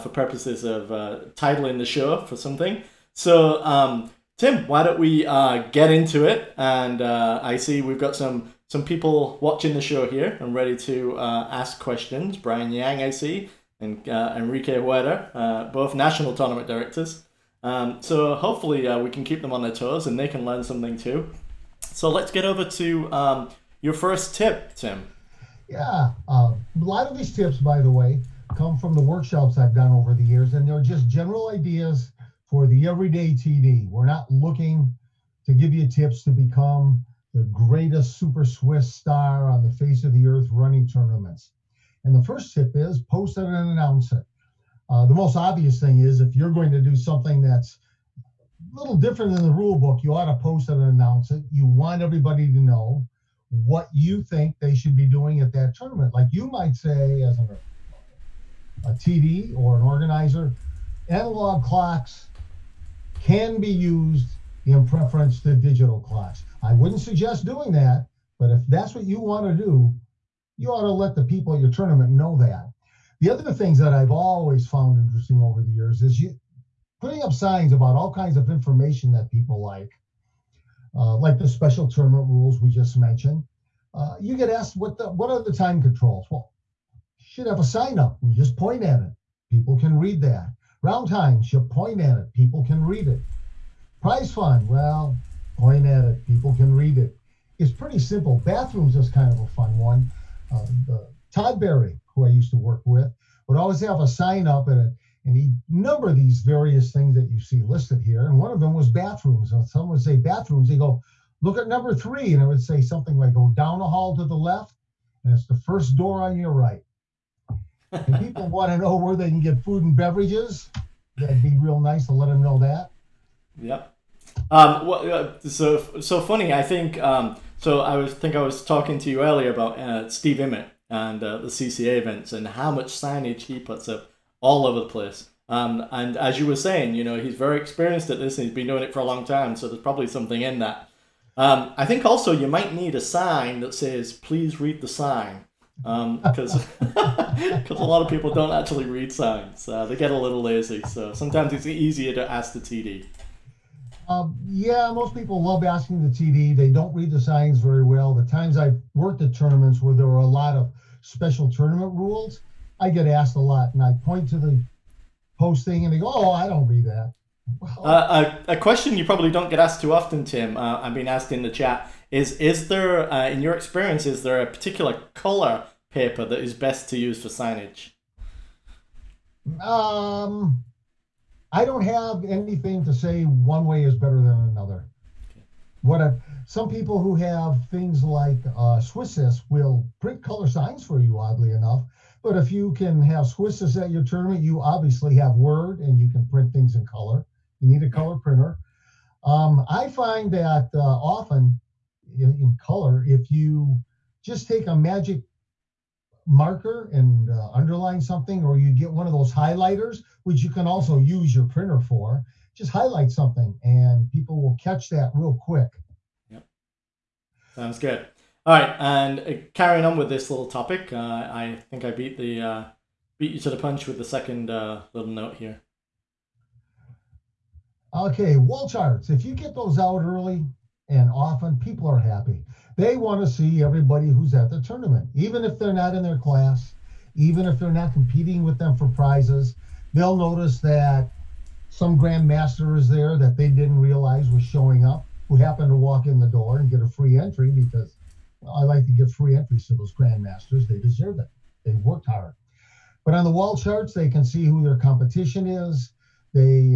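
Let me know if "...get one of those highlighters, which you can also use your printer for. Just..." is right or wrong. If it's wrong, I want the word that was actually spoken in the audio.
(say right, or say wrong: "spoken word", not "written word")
right.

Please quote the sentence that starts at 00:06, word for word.
And I see we've got some some people watching the show here and ready to uh, ask questions.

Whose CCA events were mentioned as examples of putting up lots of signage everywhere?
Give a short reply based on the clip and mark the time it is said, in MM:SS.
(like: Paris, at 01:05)
Steve Immitt, at 02:10.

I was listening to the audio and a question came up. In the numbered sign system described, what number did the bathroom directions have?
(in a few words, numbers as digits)
3.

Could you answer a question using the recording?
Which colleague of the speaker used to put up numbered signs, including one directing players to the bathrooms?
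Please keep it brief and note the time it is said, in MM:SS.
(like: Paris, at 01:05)
Todd Berry, at 01:41.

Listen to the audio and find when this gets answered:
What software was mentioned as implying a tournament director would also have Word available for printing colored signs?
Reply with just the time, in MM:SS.
03:13.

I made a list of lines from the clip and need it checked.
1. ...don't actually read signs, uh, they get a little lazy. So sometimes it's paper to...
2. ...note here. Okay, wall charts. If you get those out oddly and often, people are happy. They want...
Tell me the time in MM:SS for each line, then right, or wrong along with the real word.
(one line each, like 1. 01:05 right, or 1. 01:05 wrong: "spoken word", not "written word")
1. 02:28 wrong: "easier", not "paper"
2. 03:45 wrong: "early", not "oddly".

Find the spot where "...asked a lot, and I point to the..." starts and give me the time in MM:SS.
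02:43.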